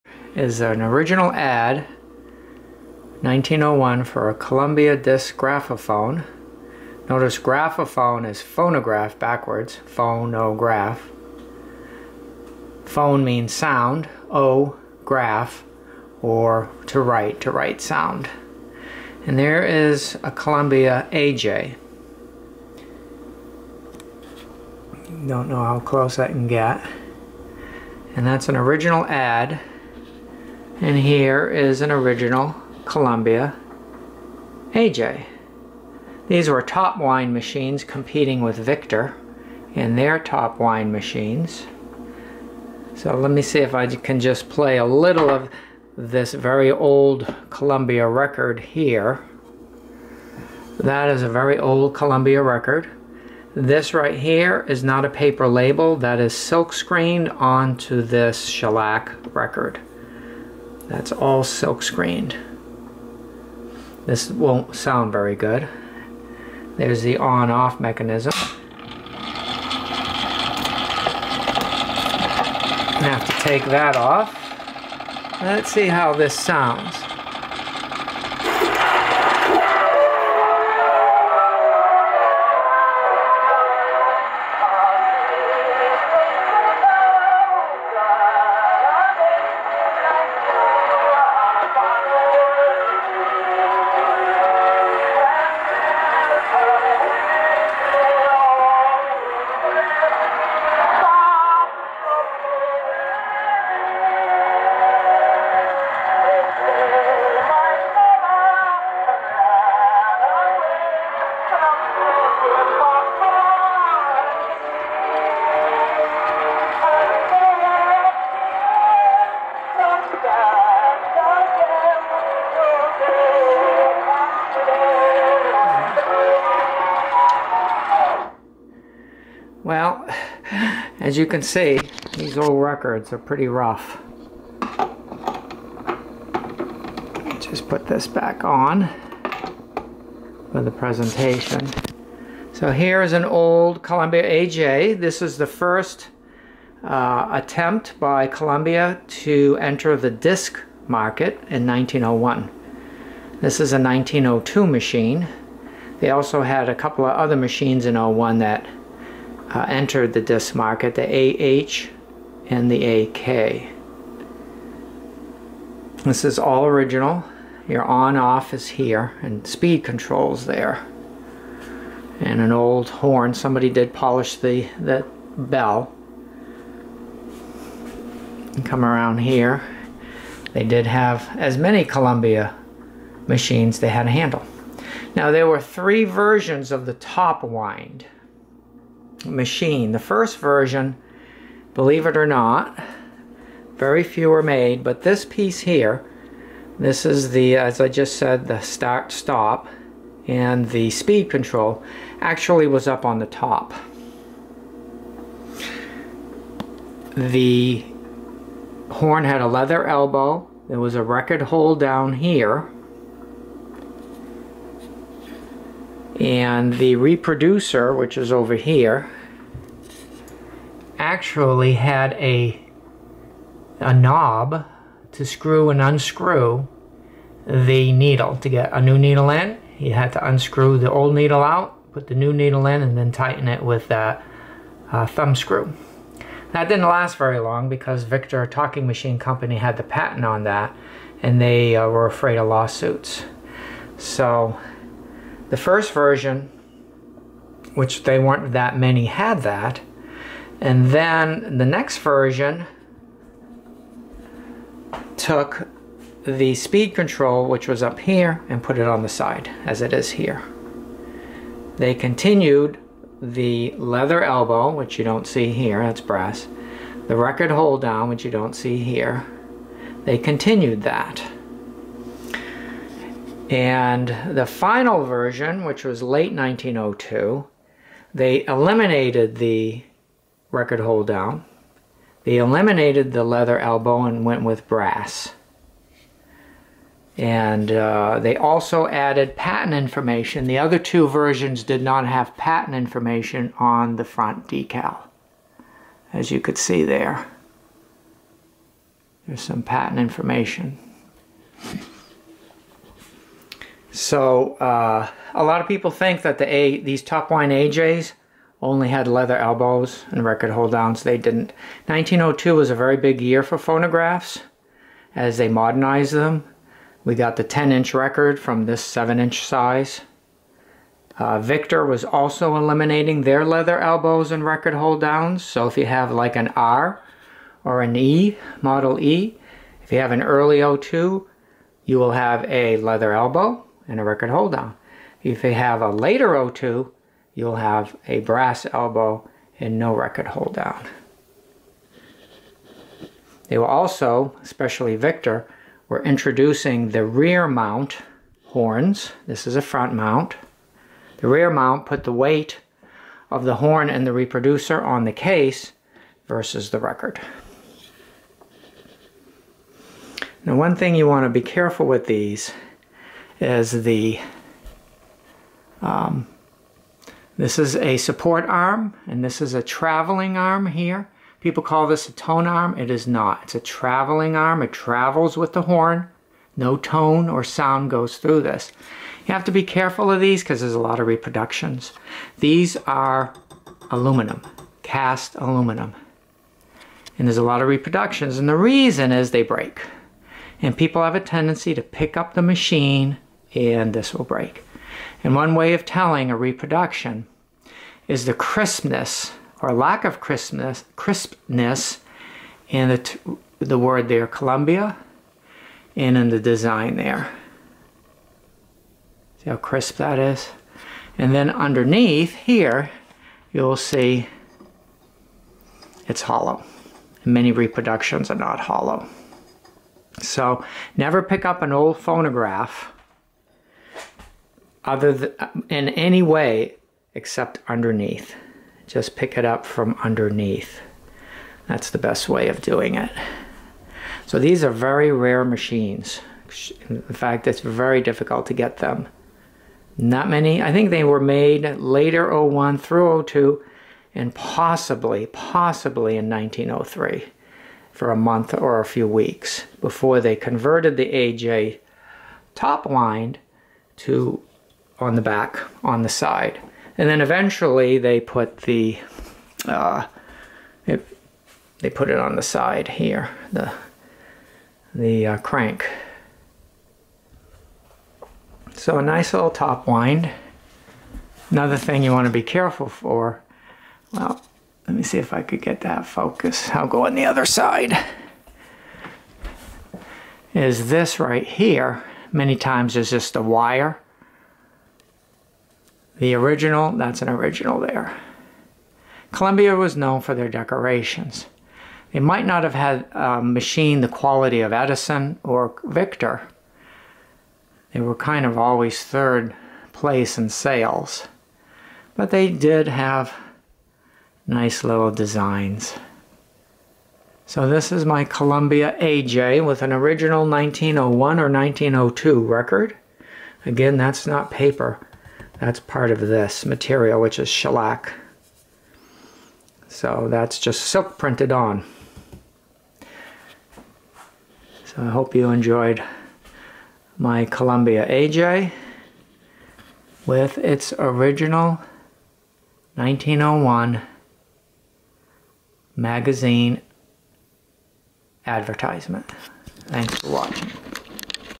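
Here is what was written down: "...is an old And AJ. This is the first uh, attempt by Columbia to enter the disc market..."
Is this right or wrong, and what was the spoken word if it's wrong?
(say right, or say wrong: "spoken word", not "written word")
wrong: "Columbia", not "And".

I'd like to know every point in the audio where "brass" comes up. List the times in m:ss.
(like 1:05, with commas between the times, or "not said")
4:25, 4:44, 5:38.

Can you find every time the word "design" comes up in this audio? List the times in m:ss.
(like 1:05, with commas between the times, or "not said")
6:46, 8:25.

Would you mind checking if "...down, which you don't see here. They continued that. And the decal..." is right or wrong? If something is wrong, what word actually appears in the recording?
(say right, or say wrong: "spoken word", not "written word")
wrong: "final", not "decal".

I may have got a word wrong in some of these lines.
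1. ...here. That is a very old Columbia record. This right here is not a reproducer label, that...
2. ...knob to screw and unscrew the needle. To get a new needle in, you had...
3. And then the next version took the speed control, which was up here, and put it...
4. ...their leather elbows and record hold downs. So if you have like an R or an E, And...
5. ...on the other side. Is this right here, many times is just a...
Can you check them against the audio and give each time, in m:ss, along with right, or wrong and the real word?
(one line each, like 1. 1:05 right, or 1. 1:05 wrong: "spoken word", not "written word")
1. 0:48 wrong: "paper", not "reproducer"
2. 3:43 right
3. 4:10 right
4. 5:23 wrong: "Model", not "And"
5. 7:57 right.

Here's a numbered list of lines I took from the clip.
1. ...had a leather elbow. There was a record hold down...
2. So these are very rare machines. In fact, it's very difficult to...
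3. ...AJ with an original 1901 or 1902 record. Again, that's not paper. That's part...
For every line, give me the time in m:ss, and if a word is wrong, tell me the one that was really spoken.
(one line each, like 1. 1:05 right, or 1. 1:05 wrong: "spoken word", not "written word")
1. 3:29 right
2. 7:14 right
3. 8:29 right.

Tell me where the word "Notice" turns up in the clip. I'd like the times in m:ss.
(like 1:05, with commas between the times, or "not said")
0:07.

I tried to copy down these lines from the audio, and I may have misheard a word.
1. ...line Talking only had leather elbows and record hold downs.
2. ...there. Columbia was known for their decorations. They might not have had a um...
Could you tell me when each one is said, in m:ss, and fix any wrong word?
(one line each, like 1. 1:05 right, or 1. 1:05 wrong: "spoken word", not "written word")
1. 5:07 wrong: "AJs", not "Talking"
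2. 8:07 right.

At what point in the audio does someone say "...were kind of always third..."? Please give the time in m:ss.
8:18.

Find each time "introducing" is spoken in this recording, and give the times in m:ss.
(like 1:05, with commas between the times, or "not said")
5:46.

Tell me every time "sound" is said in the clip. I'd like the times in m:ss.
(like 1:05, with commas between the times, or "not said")
0:13, 0:17, 1:04, 1:16, 6:17.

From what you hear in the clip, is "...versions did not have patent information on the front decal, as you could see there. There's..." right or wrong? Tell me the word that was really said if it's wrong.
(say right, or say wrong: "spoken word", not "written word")
right.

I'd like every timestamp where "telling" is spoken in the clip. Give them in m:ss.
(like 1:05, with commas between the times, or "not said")
6:35.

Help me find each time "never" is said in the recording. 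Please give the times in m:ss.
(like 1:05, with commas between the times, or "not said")
7:00.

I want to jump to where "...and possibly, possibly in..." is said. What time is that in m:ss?
7:24.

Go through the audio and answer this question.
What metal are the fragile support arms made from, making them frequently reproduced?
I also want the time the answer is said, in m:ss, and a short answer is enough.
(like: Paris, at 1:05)
Cast aluminum, at 6:24.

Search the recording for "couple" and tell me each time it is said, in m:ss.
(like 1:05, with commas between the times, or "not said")
2:36.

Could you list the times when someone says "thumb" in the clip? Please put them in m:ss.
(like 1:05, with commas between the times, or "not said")
3:55.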